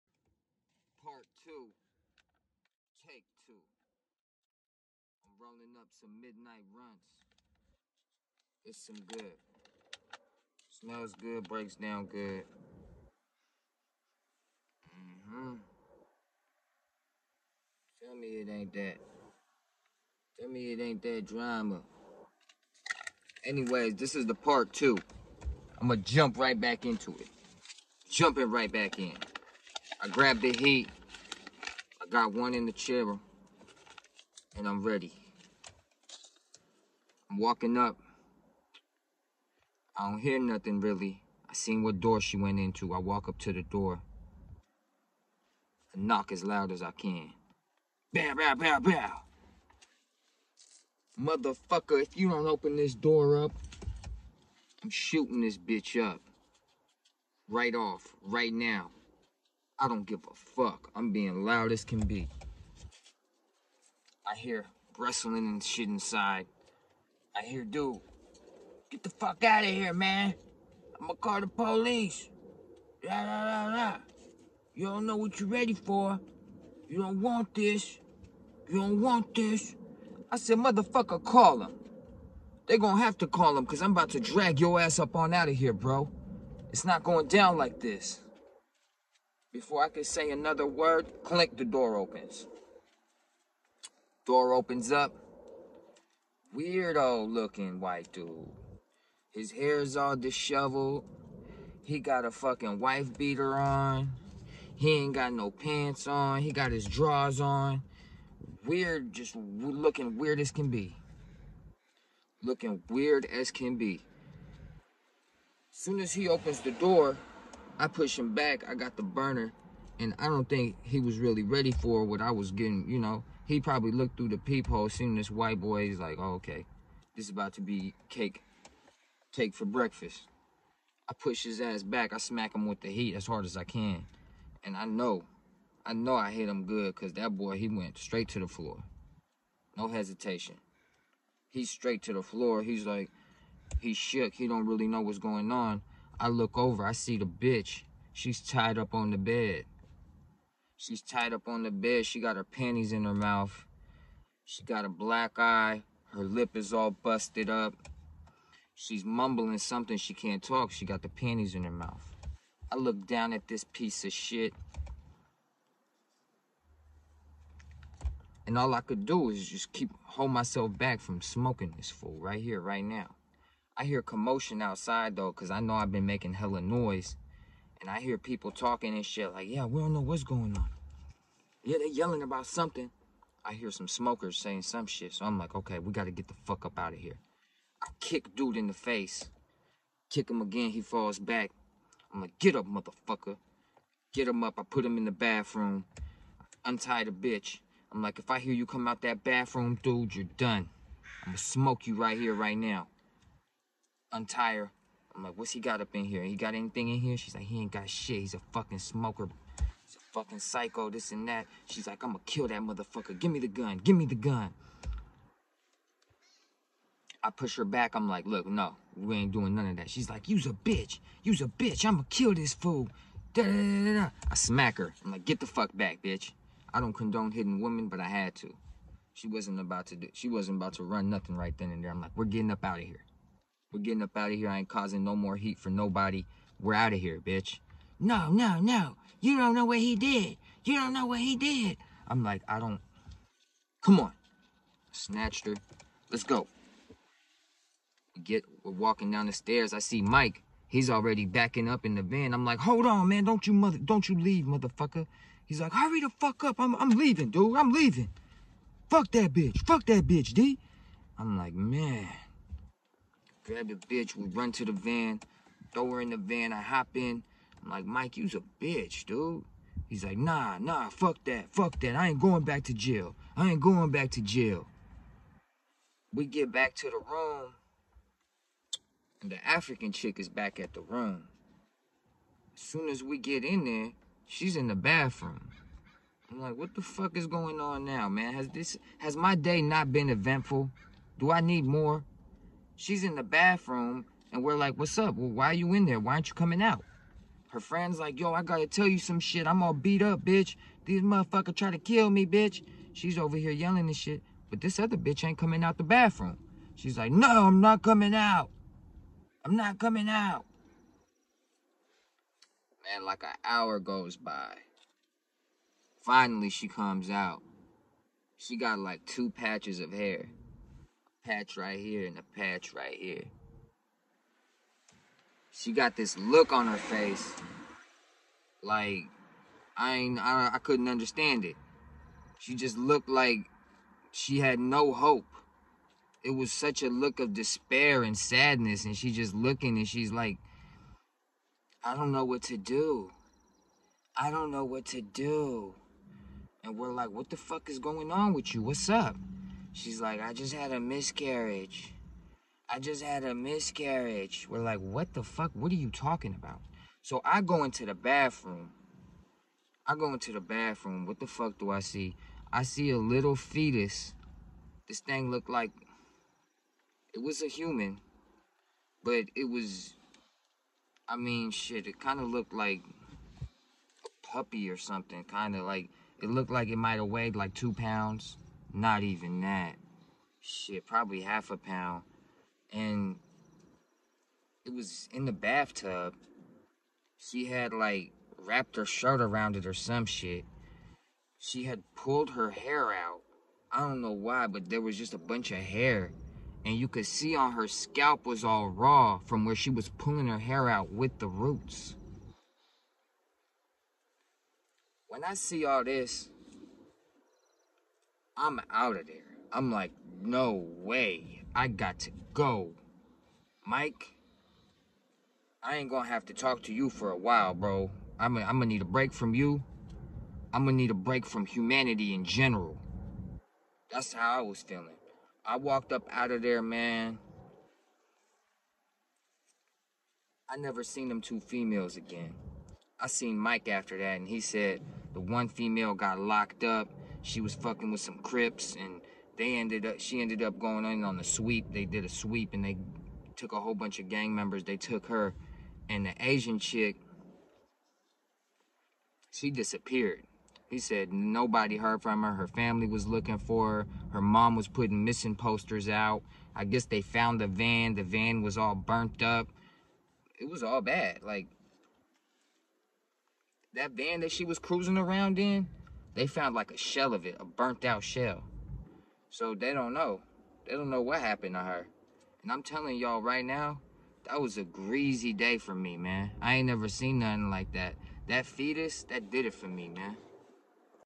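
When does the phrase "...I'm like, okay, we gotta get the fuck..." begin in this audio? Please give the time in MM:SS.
03:05.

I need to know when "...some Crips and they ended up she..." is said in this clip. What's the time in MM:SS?
07:18.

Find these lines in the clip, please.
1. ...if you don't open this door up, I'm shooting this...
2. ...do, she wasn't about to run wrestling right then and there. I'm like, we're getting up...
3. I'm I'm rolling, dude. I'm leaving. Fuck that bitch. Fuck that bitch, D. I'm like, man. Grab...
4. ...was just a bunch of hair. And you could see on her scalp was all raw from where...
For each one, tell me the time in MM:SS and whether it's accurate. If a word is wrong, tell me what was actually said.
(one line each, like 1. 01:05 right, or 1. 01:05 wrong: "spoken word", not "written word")
1. 00:52 right
2. 03:49 wrong: "nothing", not "wrestling"
3. 04:16 wrong: "leaving", not "rolling"
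4. 06:34 right.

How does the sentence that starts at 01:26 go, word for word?
It's not going down like this.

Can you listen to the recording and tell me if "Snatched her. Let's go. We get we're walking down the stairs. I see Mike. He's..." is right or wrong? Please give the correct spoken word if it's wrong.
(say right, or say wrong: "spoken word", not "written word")
right.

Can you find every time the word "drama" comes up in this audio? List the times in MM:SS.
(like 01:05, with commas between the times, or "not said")
00:21.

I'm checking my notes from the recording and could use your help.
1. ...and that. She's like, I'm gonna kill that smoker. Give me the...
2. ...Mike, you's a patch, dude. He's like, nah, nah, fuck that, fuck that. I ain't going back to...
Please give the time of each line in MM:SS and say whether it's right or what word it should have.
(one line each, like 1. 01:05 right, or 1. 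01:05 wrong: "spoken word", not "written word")
1. 03:31 wrong: "motherfucker", not "smoker"
2. 04:27 wrong: "bitch", not "patch".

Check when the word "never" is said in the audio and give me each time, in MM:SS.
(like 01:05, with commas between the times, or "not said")
07:10, 07:56.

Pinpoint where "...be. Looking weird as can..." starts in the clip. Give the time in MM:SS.
01:50.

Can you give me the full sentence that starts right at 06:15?
Kind of like, it looked like it might have weighed like two pounds.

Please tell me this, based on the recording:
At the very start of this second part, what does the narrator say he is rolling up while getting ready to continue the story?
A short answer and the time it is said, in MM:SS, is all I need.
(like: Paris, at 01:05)
midnight runs, at 00:06.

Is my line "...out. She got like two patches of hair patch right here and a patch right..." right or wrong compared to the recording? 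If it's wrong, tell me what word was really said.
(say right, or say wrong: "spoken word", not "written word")
right.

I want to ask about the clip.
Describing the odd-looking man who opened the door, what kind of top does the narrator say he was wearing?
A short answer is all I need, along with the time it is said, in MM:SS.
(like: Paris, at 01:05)
wife beater, at 01:42.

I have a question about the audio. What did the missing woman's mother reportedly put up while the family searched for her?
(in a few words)
missing posters.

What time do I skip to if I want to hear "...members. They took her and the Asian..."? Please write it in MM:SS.
07:24.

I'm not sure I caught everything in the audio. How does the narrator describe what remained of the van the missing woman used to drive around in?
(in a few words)
a burnt out shell.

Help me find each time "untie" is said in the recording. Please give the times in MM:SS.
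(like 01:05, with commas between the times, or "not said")
03:16, 03:24.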